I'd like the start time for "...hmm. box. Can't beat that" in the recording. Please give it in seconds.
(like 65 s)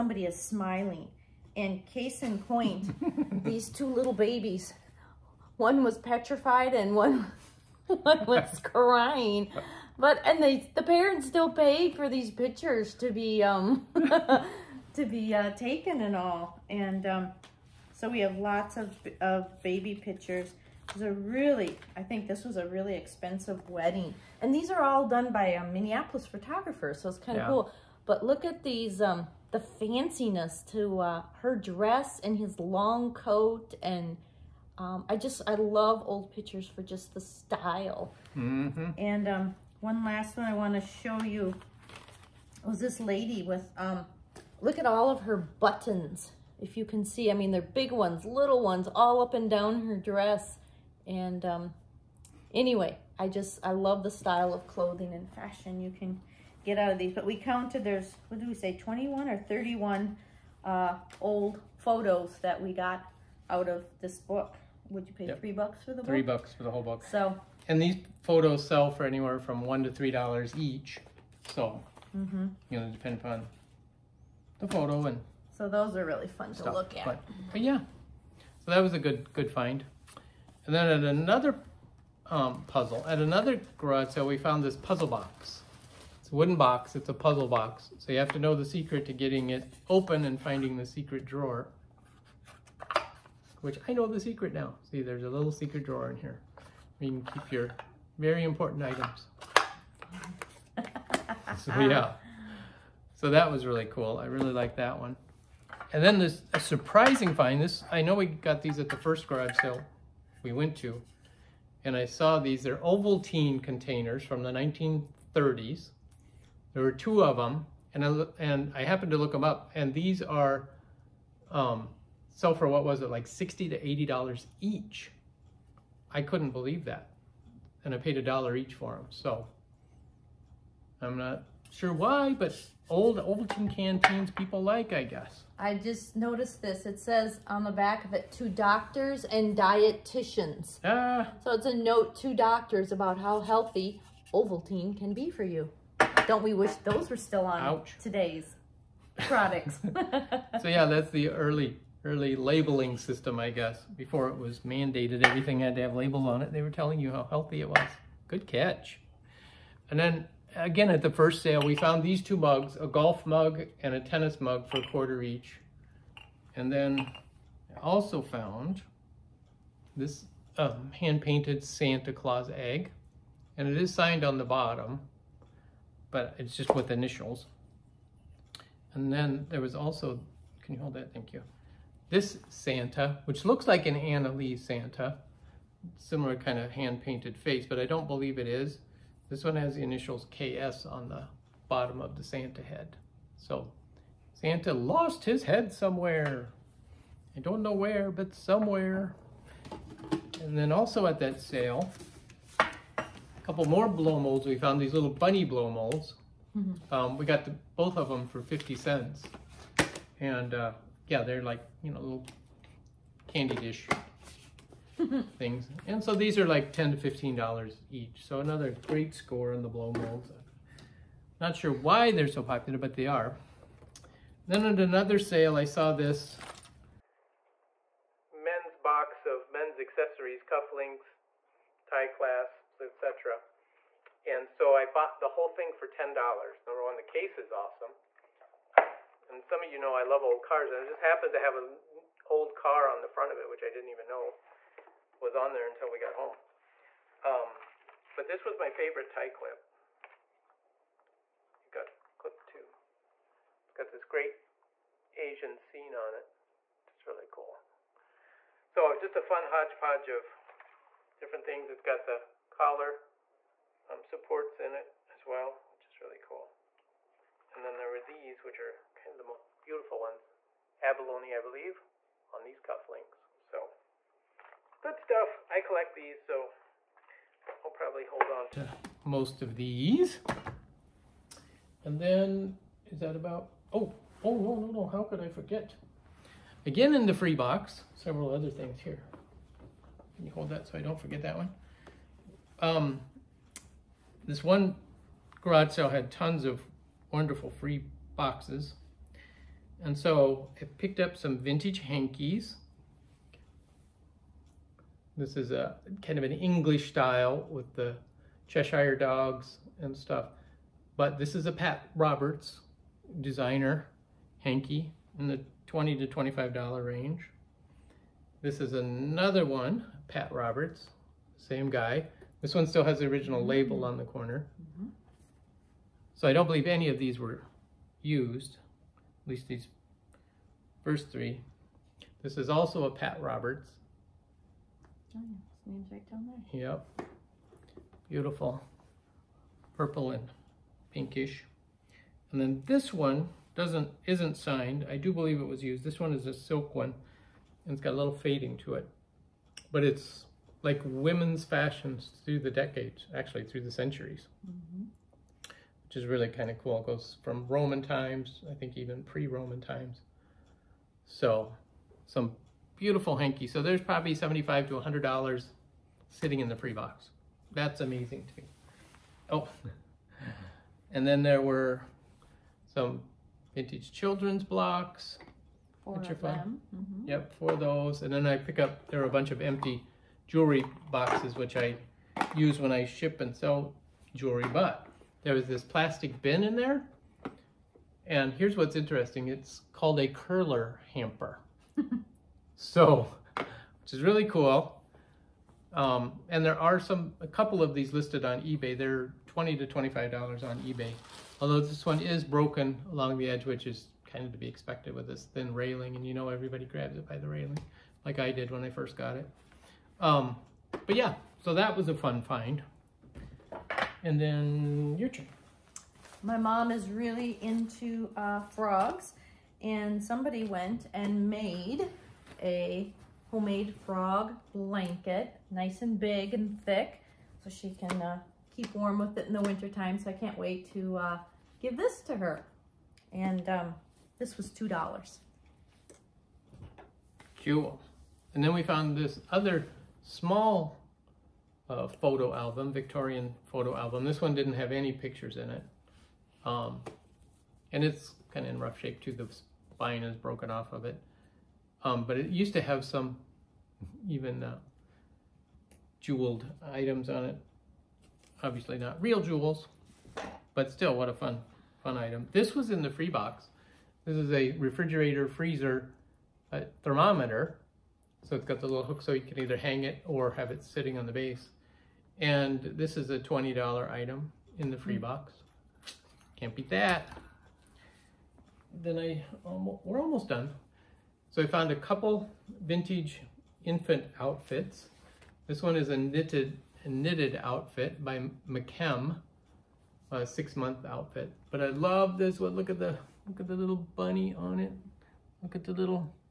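474 s.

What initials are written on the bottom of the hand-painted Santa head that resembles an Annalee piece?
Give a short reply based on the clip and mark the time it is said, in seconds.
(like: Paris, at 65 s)
KS, at 190 s.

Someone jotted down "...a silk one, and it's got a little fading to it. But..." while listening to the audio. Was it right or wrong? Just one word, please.
right.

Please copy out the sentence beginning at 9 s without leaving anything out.
But, and they, the parents still paid for these pictures to be, um, to be uh, taken and all.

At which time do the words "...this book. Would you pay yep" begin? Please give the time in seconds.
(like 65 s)
64 s.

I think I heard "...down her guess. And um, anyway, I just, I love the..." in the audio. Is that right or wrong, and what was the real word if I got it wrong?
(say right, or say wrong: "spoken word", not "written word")
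wrong: "dress", not "guess".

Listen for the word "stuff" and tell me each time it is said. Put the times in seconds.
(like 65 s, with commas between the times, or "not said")
76 s, 274 s, 309 s.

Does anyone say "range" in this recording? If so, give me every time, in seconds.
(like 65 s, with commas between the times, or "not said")
316 s.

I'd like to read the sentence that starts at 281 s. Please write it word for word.
And then, is that about, oh, oh, no, no, no, how could I forget?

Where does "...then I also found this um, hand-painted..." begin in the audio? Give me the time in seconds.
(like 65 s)
166 s.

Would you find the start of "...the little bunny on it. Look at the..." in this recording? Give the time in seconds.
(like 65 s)
493 s.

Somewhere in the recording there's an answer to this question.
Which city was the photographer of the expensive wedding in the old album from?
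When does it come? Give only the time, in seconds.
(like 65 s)
25 s.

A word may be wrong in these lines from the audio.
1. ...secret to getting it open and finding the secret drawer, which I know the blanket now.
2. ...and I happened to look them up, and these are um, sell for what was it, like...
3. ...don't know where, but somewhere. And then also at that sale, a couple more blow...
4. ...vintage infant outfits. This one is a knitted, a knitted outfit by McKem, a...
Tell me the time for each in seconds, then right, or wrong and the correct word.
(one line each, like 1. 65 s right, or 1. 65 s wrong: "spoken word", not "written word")
1. 88 s wrong: "secret", not "blanket"
2. 118 s right
3. 197 s right
4. 482 s right.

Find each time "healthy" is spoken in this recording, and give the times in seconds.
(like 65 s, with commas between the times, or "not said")
143 s, 157 s.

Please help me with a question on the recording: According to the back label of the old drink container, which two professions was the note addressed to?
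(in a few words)
doctors and dietitians.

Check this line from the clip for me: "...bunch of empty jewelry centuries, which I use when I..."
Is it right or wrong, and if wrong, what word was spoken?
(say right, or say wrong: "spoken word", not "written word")
wrong: "boxes", not "centuries".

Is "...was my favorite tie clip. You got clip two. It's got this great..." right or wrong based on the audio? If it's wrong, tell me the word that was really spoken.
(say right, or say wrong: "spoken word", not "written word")
right.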